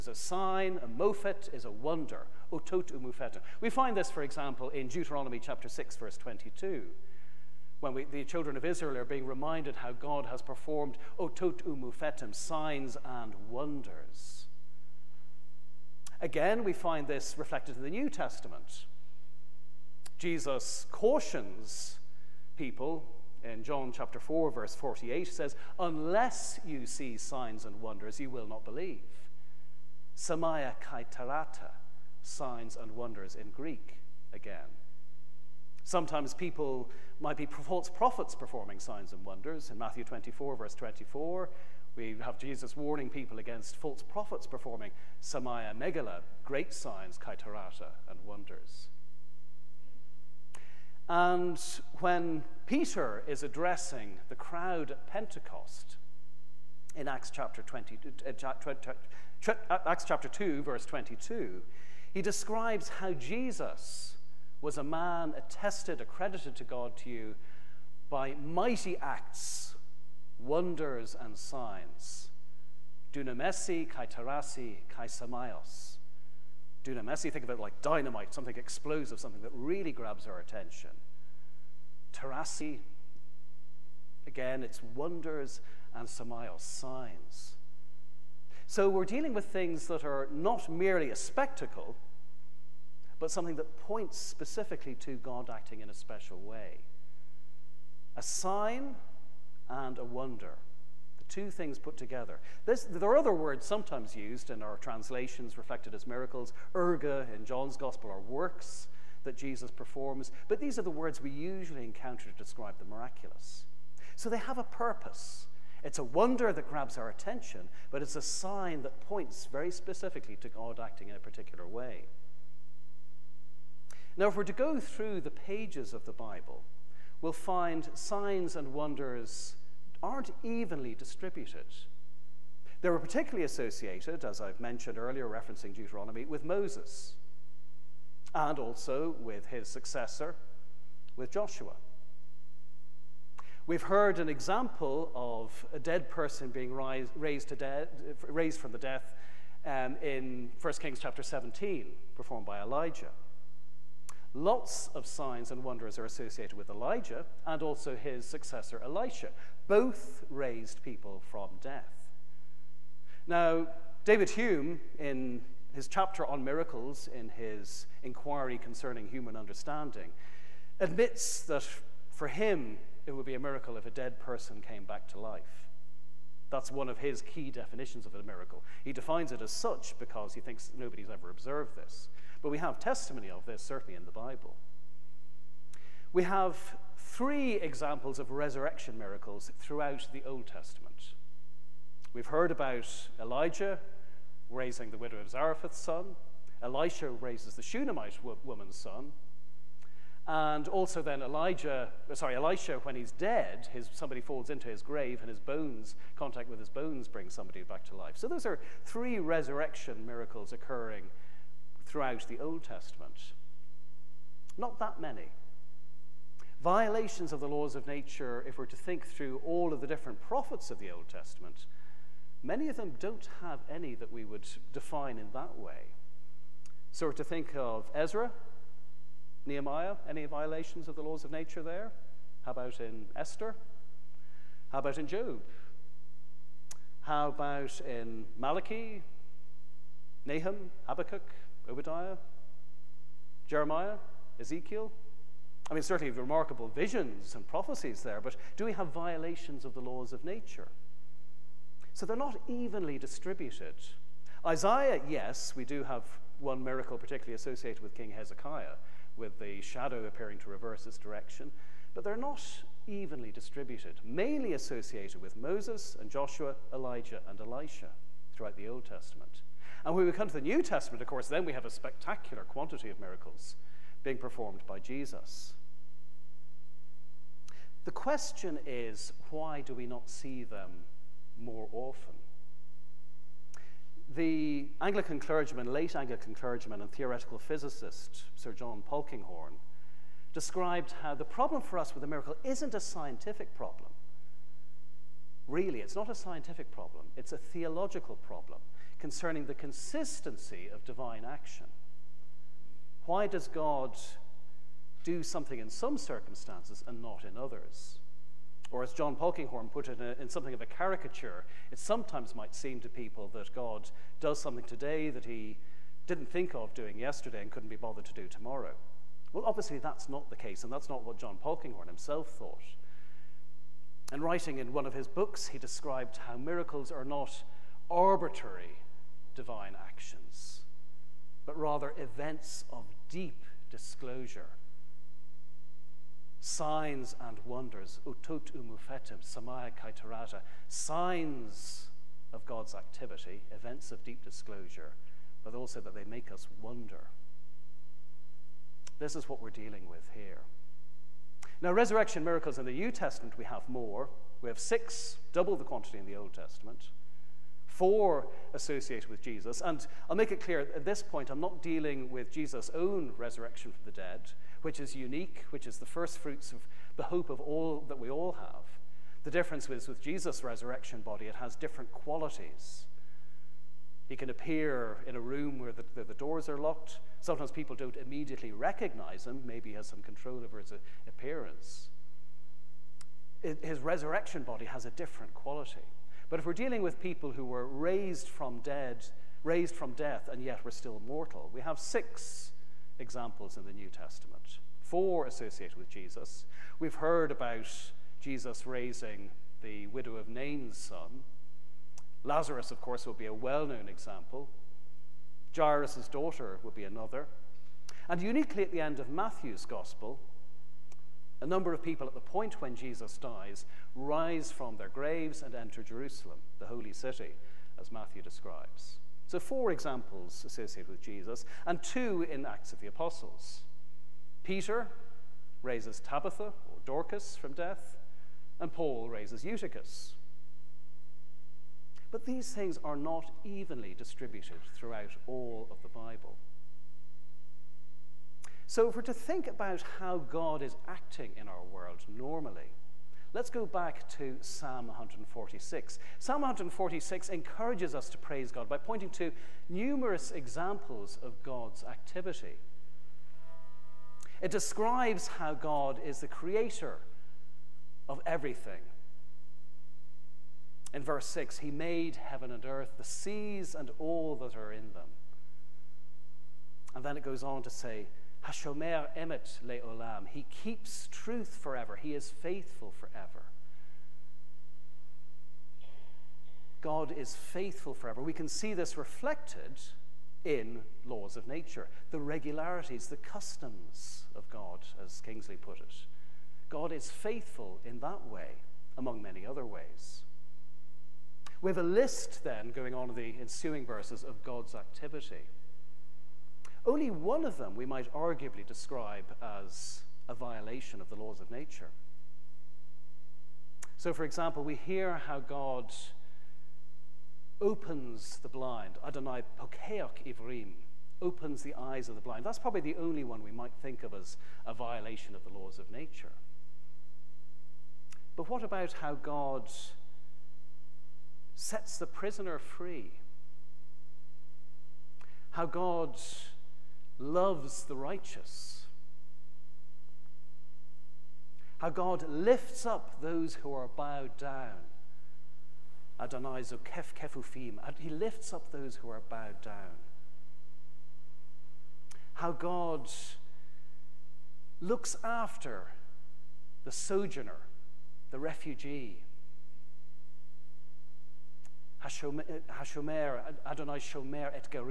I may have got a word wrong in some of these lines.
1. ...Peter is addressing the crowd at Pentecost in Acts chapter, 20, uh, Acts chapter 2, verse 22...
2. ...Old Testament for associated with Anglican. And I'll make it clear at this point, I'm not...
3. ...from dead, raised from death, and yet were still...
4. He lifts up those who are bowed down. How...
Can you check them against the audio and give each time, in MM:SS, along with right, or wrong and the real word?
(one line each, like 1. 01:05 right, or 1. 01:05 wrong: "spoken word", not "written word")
1. 00:52 right
2. 05:56 wrong: "Jesus", not "Anglican"
3. 06:28 right
4. 08:57 right.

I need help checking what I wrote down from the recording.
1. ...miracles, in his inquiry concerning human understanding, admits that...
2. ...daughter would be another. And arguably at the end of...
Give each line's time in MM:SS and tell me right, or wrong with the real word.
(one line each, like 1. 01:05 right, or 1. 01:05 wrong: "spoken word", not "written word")
1. 02:46 right
2. 06:46 wrong: "uniquely", not "arguably".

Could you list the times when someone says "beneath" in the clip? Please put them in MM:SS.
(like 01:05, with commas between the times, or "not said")
not said.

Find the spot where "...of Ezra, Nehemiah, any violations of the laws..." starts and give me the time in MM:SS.
03:47.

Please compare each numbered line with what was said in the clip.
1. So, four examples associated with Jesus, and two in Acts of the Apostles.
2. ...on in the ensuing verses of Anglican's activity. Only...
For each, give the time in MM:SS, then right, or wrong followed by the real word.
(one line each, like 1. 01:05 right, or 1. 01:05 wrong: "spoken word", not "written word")
1. 06:59 right
2. 08:12 wrong: "God", not "Anglican".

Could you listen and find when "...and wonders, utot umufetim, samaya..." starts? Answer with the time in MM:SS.
05:37.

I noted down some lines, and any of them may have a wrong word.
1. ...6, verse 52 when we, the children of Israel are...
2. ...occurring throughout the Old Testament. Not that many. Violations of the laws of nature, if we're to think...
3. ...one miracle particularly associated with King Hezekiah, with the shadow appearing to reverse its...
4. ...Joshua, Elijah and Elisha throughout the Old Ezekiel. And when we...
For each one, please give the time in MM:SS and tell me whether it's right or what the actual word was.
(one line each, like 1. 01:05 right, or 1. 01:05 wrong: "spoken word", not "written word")
1. 00:05 wrong: "22", not "52"
2. 03:30 right
3. 04:16 right
4. 04:26 wrong: "Testament", not "Ezekiel".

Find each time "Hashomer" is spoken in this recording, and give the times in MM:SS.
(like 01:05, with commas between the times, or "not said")
07:48, 09:12.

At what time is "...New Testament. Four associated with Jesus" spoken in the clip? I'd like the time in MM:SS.
06:33.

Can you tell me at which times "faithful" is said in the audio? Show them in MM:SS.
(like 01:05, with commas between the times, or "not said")
07:52, 07:57, 08:07.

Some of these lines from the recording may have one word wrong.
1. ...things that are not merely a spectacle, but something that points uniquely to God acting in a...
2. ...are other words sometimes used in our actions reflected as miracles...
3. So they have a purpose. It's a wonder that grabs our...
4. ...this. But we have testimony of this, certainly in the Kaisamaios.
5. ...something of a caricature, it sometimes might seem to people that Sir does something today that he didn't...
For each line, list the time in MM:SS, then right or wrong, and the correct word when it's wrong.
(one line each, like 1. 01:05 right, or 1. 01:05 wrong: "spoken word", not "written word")
1. 01:29 wrong: "specifically", not "uniquely"
2. 01:43 wrong: "translations", not "actions"
3. 01:54 right
4. 03:01 wrong: "Bible", not "Kaisamaios"
5. 05:10 wrong: "God", not "Sir".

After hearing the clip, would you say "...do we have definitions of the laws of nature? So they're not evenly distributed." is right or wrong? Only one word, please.
wrong.